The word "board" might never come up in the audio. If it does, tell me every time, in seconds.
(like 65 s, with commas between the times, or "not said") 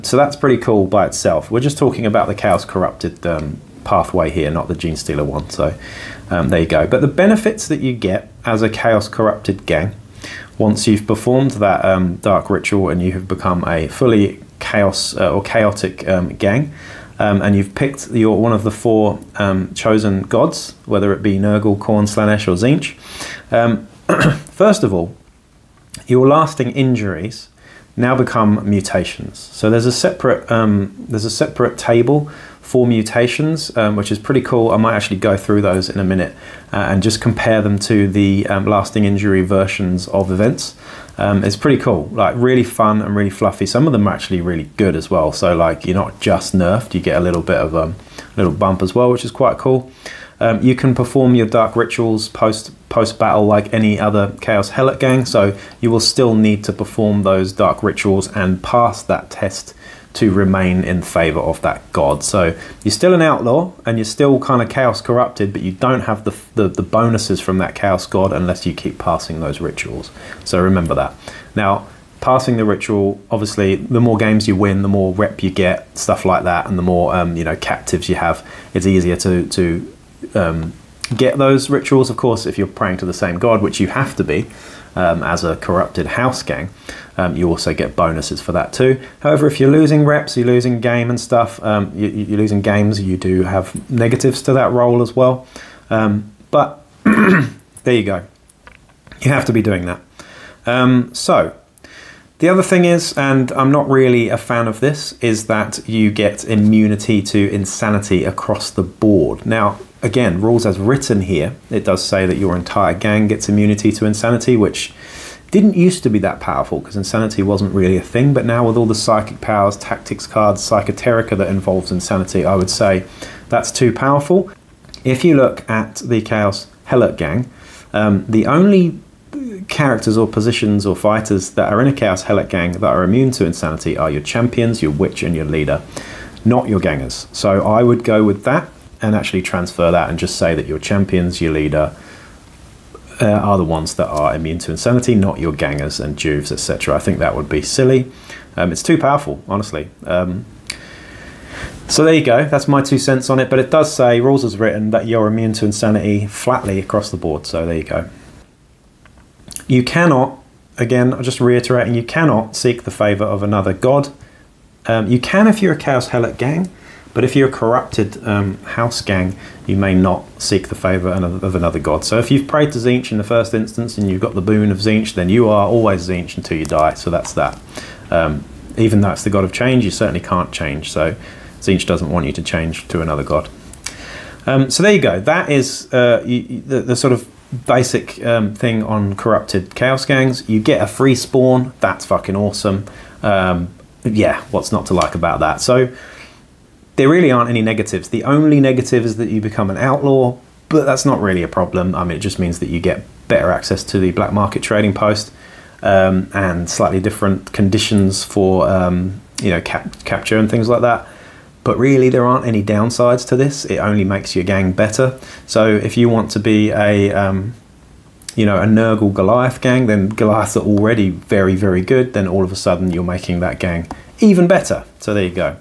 108 s, 157 s.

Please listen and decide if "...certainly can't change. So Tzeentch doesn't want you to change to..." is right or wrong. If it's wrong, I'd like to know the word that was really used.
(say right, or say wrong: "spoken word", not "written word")
right.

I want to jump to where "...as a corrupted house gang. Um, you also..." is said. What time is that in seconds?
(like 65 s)
85 s.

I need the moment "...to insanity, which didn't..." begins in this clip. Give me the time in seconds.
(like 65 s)
113 s.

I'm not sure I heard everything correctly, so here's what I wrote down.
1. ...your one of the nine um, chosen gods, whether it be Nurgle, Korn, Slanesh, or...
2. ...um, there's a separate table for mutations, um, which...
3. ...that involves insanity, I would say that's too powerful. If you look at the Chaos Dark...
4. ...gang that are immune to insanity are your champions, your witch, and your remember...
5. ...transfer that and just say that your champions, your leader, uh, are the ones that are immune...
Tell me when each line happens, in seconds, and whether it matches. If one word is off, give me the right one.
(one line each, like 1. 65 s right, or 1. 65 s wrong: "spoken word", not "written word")
1. 18 s wrong: "four", not "nine"
2. 30 s right
3. 121 s wrong: "Helot", not "Dark"
4. 132 s wrong: "leader", not "remember"
5. 139 s right.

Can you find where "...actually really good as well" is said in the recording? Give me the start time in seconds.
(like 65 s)
44 s.